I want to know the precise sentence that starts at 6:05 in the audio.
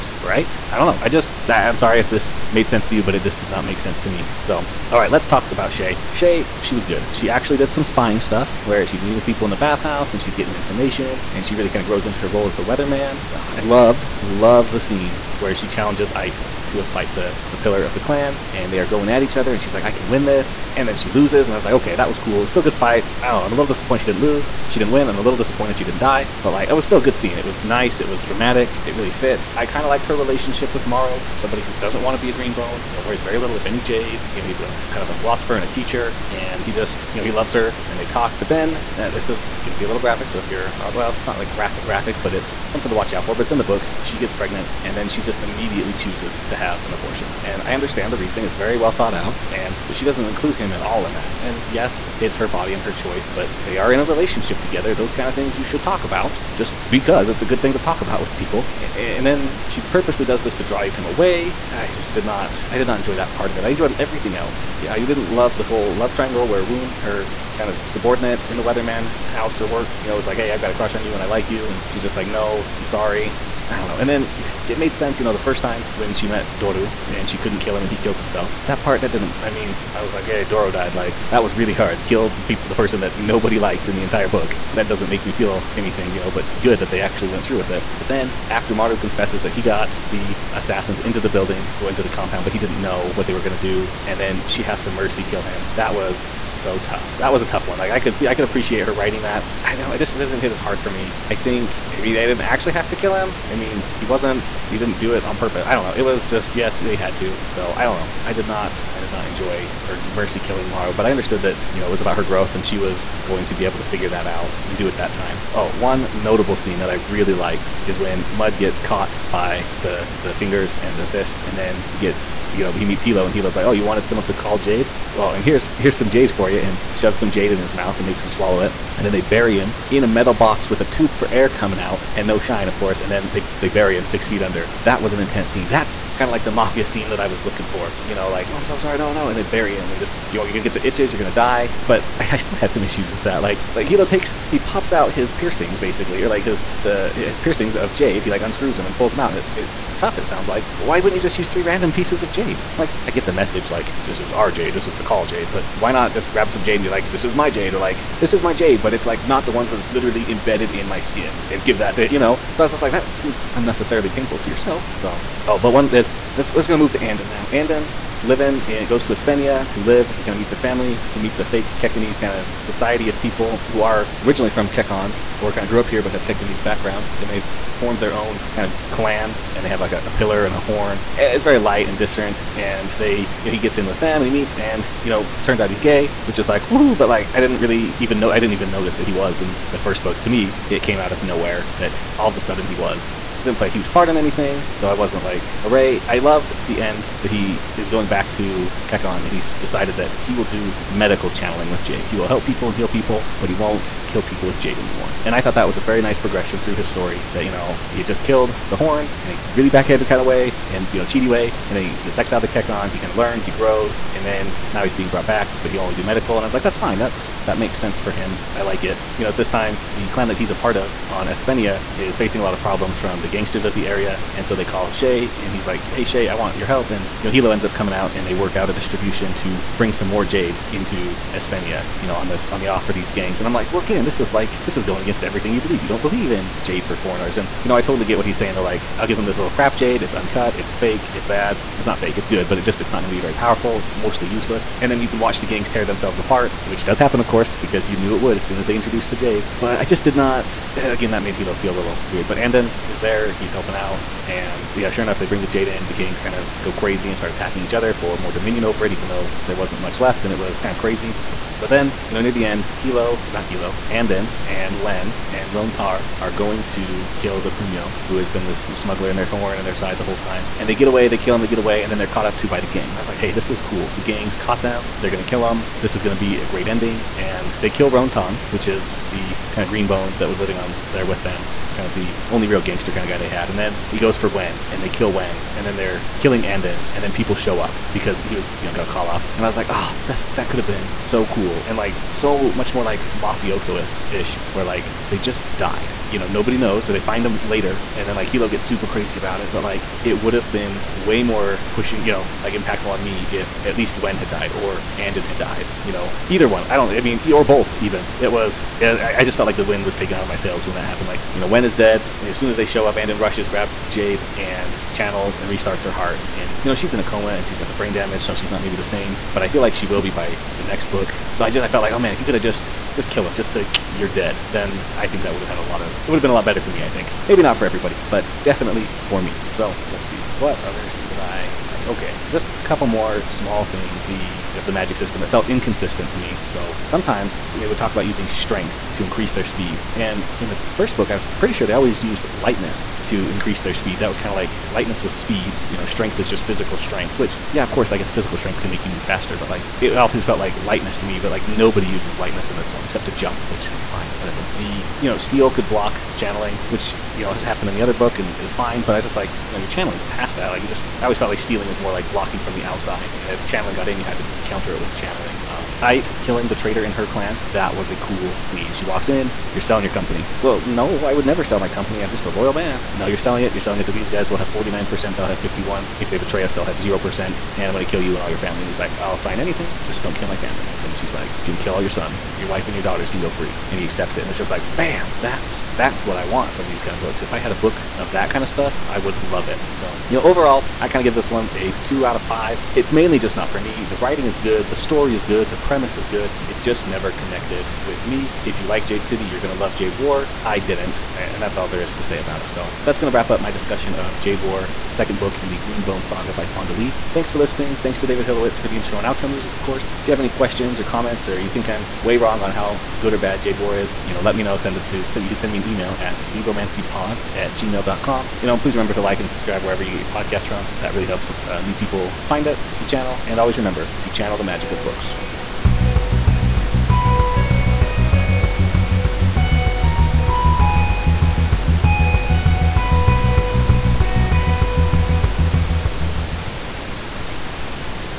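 Um, Ayt killing the traitor in her clan.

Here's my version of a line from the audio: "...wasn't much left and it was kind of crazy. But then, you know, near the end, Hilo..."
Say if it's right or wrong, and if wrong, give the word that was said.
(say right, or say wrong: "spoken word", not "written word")
right.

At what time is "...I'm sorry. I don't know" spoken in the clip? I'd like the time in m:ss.
1:12.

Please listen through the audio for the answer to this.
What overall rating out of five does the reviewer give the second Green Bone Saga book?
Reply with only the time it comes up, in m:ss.
6:31.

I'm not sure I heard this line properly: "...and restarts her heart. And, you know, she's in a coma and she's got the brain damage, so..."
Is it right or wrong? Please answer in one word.
right.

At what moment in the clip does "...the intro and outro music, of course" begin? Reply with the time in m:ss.
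6:48.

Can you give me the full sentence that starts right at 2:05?
Well, and here's here's some jade for you," and shoves some jade in his mouth and makes him swallow it.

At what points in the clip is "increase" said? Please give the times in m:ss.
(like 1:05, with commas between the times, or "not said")
5:39, 5:43.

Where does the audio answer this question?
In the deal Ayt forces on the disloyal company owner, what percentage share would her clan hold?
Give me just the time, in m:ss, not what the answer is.
6:14.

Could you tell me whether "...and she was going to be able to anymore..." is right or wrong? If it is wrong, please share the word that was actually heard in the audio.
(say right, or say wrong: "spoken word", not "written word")
wrong: "figure", not "anymore".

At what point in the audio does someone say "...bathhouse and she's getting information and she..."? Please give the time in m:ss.
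0:09.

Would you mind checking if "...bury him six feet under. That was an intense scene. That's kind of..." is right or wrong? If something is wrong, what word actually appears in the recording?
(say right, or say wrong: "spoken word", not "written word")
right.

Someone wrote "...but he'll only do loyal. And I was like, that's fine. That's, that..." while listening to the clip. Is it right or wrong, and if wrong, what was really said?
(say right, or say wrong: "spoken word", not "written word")
wrong: "medical", not "loyal".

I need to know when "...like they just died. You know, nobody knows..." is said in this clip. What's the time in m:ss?
4:54.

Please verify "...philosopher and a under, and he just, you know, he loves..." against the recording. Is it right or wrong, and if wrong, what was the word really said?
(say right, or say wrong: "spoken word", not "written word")
wrong: "teacher", not "under".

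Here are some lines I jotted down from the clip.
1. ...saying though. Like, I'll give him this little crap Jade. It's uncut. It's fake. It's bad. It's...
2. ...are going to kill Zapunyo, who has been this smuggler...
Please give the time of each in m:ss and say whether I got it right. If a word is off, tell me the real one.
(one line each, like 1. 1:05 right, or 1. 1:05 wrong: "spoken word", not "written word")
1. 3:58 right
2. 4:26 right.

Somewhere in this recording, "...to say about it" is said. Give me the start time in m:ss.
6:41.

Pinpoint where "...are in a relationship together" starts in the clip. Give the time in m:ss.
0:53.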